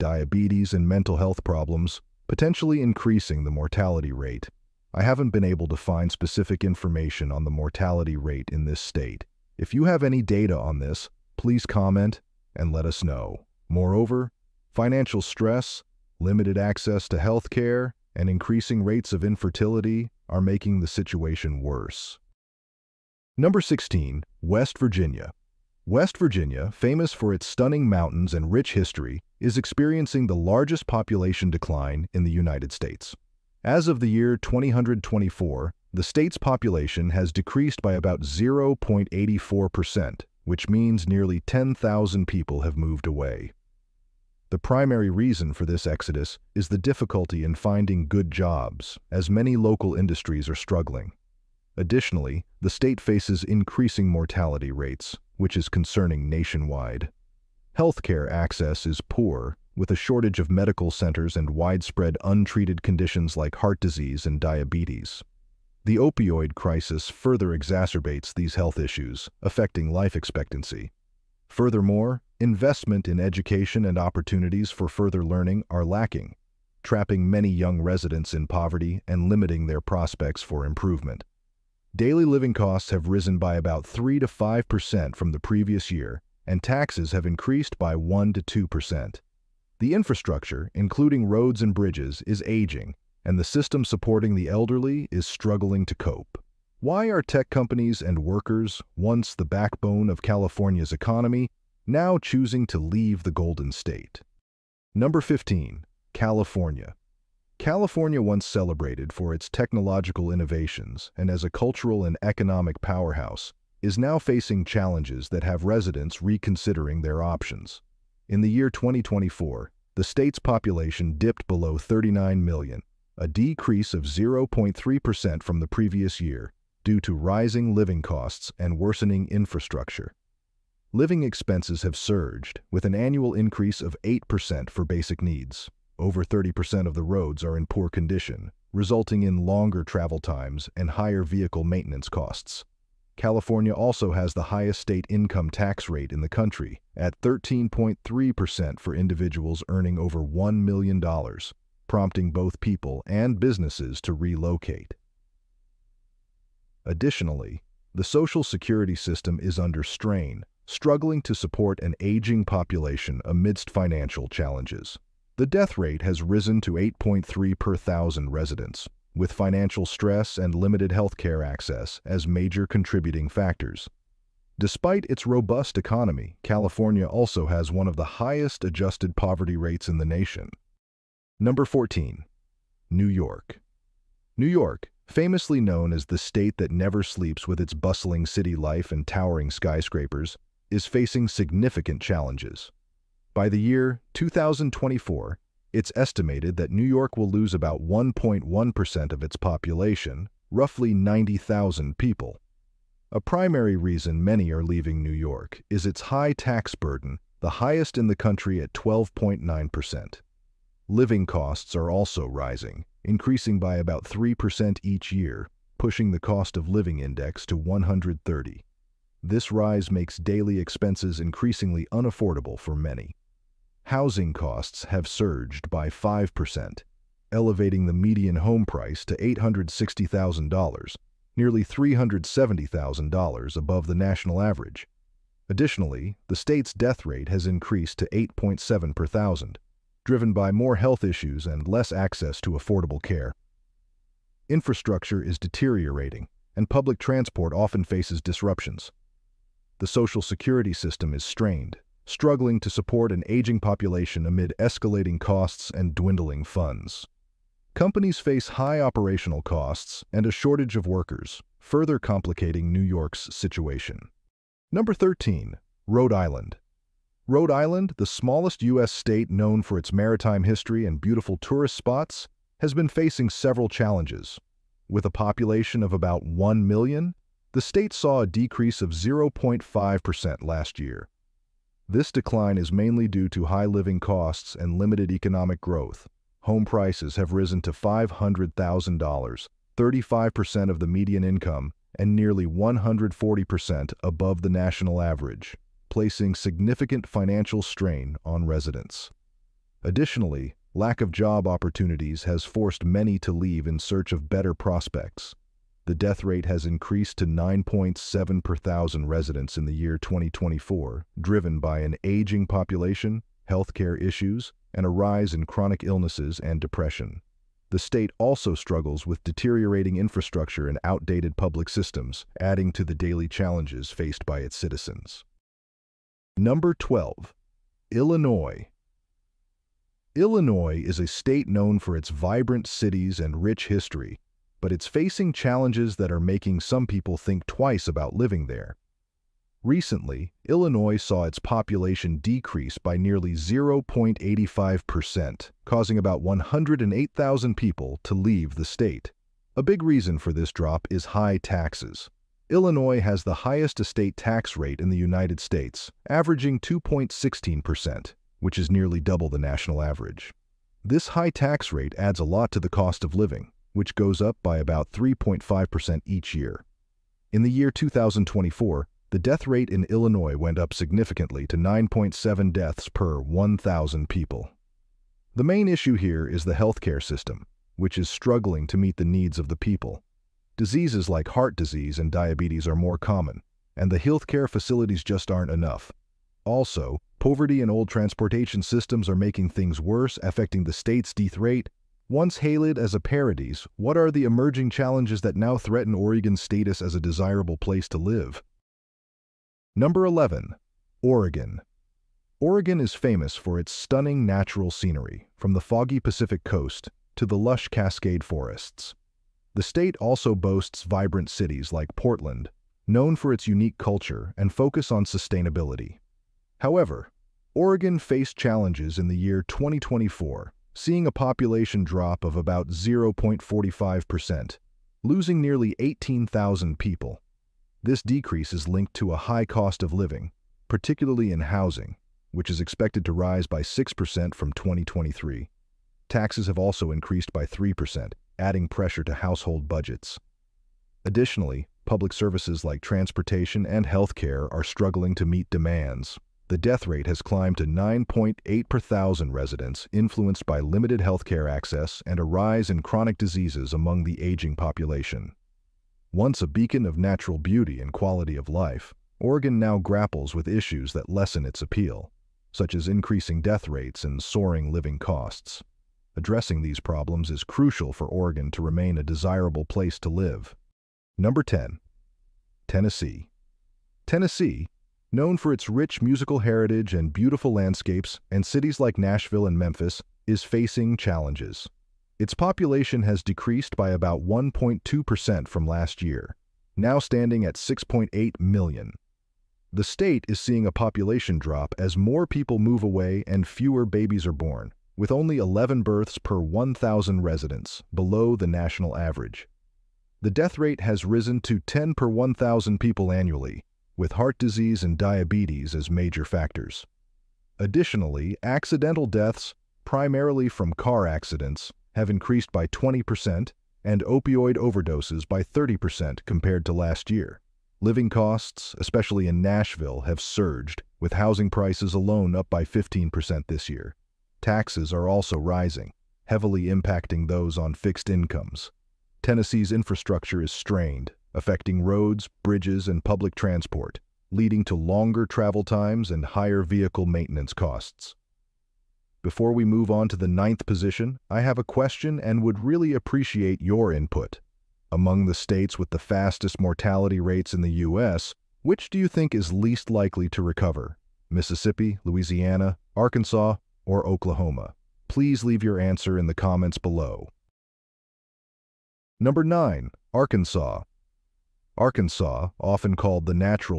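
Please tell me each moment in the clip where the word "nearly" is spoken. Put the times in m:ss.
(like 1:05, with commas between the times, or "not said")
0:41, 3:51, 4:52, 5:42, 5:58, 7:05.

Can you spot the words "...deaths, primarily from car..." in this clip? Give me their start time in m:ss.
8:29.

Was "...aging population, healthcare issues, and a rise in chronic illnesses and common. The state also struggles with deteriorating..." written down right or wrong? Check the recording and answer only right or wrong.
wrong.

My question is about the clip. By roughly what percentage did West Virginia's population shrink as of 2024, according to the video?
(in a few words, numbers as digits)
0.84%.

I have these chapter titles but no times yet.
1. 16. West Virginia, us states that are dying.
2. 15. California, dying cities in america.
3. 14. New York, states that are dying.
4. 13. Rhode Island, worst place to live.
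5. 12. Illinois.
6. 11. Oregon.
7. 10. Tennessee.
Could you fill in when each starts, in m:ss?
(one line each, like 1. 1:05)
1. 0:23
2. 1:45
3. 3:01
4. 4:24
5. 5:26
6. 6:39
7. 7:51.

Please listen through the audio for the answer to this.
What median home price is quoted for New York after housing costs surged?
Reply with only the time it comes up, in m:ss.
3:49.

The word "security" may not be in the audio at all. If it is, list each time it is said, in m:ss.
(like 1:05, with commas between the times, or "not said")
2:38, 4:10.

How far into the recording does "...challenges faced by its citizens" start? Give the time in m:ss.
5:23.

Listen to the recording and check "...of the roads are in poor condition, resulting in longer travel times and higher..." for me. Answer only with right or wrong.
right.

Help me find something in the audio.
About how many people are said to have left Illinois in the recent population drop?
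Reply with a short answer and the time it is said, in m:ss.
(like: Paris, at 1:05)
108,000, at 5:46.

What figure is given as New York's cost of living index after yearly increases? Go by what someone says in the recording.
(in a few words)
130.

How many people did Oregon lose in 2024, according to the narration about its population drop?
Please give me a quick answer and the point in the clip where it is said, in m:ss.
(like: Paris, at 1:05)
18,000, at 7:05.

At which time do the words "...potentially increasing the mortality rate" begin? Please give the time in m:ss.
0:02.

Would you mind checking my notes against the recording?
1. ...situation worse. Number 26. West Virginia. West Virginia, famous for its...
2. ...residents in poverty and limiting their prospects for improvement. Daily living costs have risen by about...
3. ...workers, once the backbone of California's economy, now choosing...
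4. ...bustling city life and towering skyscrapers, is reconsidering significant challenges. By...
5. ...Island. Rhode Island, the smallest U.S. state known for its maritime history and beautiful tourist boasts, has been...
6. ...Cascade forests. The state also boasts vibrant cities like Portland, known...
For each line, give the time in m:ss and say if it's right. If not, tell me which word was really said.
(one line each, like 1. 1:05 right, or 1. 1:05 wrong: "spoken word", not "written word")
1. 0:20 wrong: "16", not "26"
2. 1:17 right
3. 1:38 right
4. 3:07 wrong: "facing", not "reconsidering"
5. 4:26 wrong: "spots", not "boasts"
6. 6:47 right.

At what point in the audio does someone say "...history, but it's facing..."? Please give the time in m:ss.
5:33.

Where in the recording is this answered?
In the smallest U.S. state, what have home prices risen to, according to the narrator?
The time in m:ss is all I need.
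4:47.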